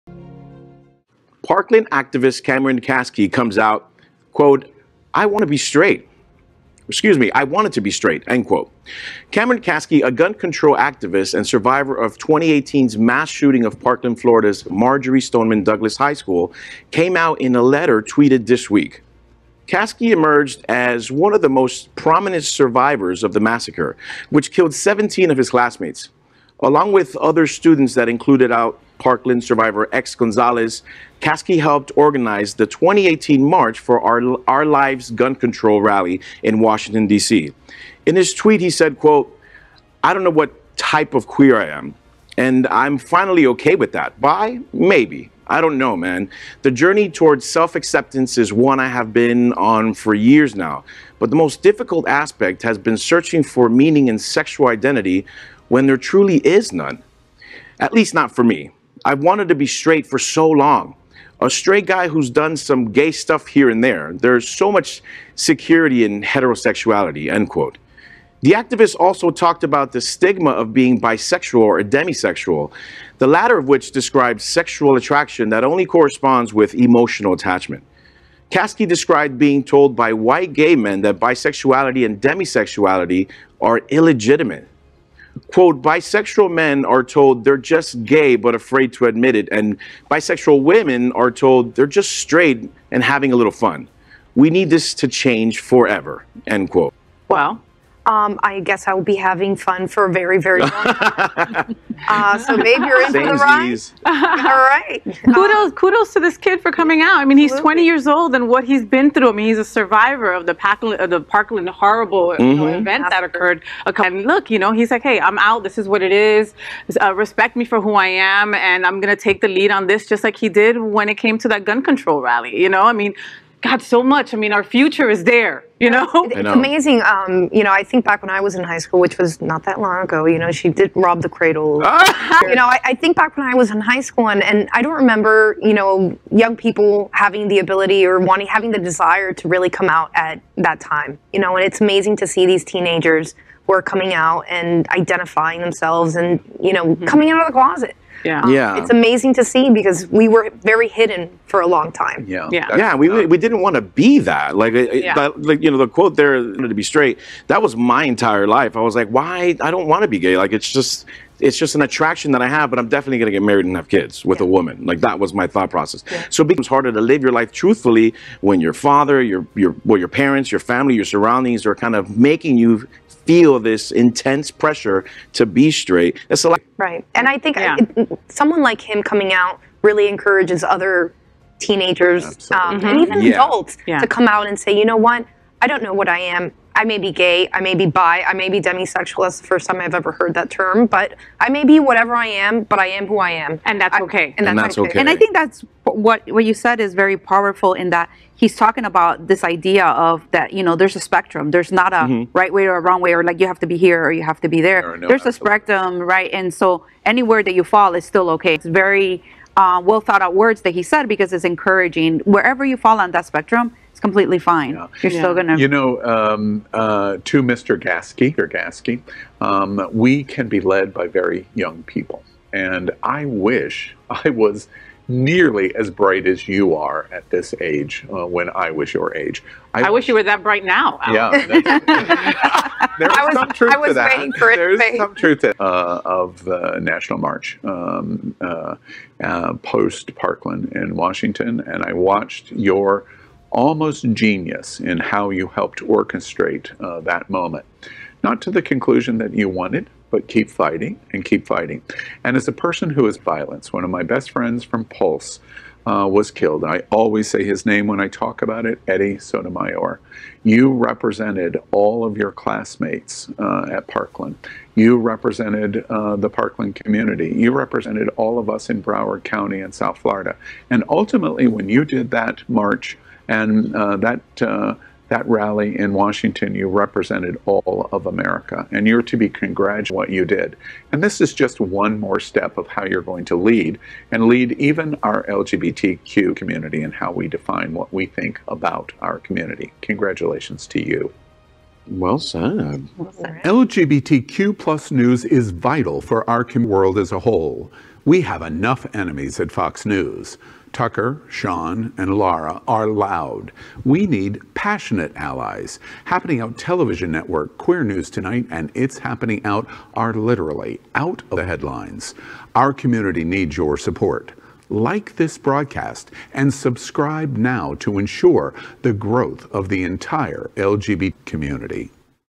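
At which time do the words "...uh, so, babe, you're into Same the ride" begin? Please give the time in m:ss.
1:42.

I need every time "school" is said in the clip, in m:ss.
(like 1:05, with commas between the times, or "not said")
0:16, 2:08, 2:14.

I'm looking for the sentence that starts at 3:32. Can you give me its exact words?
Wherever you fall on that spectrum, it's completely fine.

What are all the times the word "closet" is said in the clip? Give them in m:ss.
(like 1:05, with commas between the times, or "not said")
2:27.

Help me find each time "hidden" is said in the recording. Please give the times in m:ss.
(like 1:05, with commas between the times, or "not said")
2:30.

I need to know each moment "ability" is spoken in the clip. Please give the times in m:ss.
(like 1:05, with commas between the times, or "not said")
2:17.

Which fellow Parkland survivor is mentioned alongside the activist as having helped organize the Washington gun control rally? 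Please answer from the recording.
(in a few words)
X Gonzalez.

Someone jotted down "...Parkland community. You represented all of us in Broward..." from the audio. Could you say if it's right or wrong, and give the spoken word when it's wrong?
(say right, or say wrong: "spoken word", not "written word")
right.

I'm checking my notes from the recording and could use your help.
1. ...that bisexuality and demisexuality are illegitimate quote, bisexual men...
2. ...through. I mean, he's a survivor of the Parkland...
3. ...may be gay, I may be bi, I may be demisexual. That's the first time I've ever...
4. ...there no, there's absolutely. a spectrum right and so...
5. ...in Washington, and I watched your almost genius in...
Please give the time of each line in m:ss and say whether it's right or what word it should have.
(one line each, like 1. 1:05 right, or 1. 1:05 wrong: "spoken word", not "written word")
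1. 1:21 right
2. 1:49 right
3. 3:06 right
4. 3:24 right
5. 4:00 right.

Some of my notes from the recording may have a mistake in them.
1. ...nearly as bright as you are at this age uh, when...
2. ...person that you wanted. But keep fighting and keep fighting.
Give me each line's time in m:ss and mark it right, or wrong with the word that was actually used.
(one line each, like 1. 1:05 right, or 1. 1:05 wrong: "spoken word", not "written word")
1. 3:45 right
2. 4:08 wrong: "conclusion", not "person".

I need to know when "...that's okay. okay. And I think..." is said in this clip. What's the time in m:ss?
3:14.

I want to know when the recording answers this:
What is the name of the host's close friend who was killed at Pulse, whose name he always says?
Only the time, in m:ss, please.
4:18.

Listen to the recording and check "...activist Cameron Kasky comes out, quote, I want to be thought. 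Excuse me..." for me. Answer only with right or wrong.
wrong.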